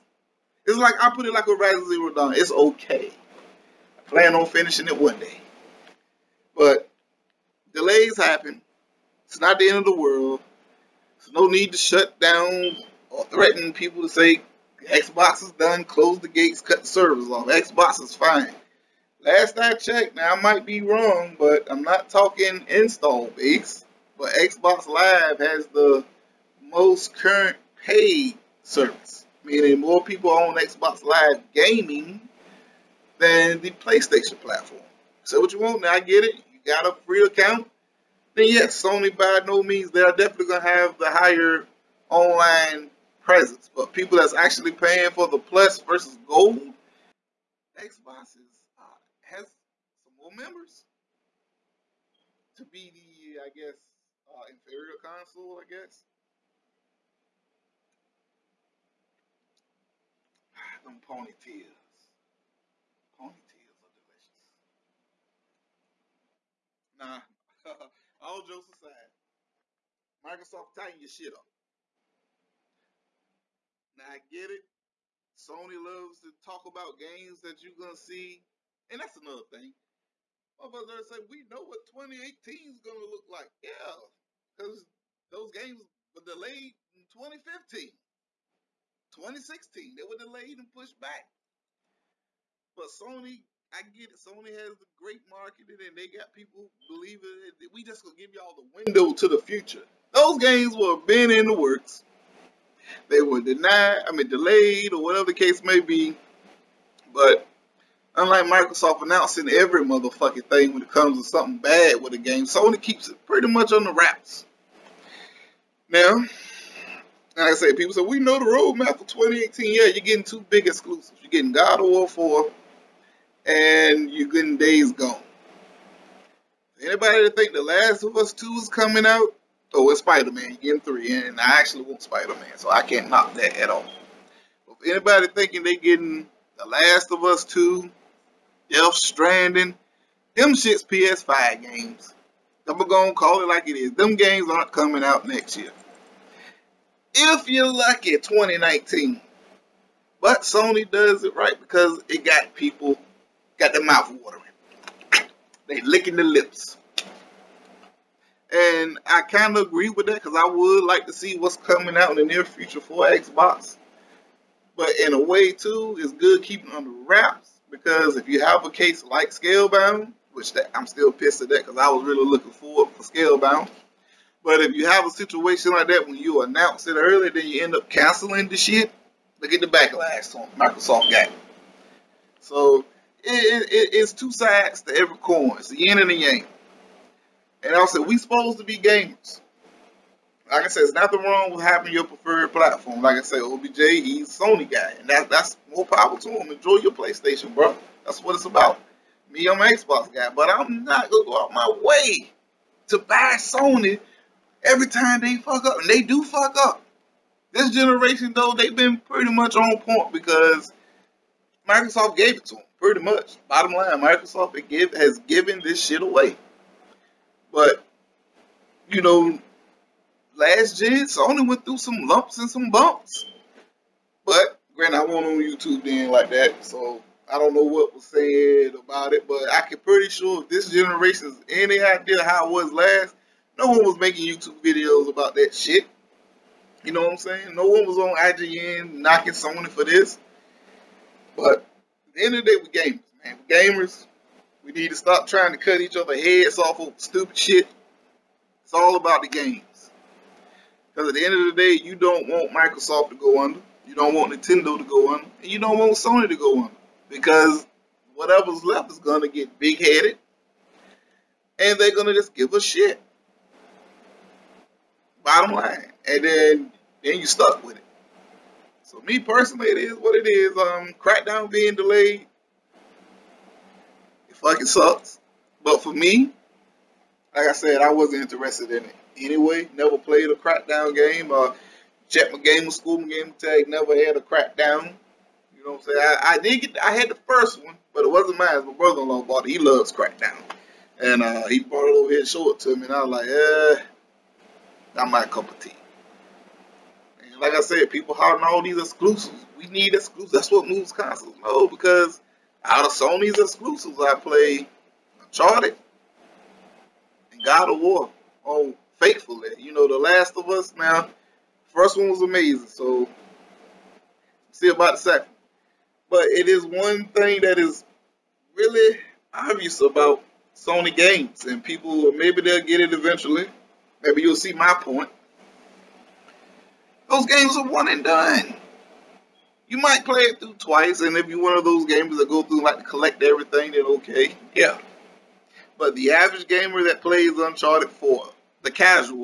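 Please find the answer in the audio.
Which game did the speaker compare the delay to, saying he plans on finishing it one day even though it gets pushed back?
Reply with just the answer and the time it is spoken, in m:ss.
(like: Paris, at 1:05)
Horizon Zero Dawn, at 0:01.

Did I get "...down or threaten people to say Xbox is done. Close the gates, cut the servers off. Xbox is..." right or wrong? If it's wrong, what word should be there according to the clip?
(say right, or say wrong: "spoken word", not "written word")
right.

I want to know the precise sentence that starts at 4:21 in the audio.
And they're going to just give a shit.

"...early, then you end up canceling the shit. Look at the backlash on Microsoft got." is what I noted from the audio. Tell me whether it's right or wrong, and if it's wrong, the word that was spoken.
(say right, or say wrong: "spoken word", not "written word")
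right.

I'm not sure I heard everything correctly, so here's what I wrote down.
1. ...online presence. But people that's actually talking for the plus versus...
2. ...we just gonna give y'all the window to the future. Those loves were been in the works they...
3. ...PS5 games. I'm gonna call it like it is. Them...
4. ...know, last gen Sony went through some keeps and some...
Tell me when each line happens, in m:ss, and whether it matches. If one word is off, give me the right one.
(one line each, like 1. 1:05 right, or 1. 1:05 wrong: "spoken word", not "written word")
1. 0:42 wrong: "paying", not "talking"
2. 1:37 wrong: "games", not "loves"
3. 2:20 right
4. 3:39 wrong: "lumps", not "keeps".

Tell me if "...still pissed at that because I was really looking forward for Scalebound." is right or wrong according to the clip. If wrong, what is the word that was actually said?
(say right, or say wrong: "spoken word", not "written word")
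right.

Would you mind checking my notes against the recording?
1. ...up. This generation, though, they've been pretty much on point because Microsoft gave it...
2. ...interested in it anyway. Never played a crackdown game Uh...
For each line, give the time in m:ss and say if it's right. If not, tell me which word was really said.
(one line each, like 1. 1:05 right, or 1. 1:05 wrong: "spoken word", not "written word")
1. 3:26 right
2. 4:38 right.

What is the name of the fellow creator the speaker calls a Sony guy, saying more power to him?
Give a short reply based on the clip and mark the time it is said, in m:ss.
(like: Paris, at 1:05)
OBJ, at 3:13.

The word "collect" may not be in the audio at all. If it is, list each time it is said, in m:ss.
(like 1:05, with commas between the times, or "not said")
5:32.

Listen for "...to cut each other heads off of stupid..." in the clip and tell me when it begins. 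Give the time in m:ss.
4:05.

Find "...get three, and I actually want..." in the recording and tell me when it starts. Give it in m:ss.
2:10.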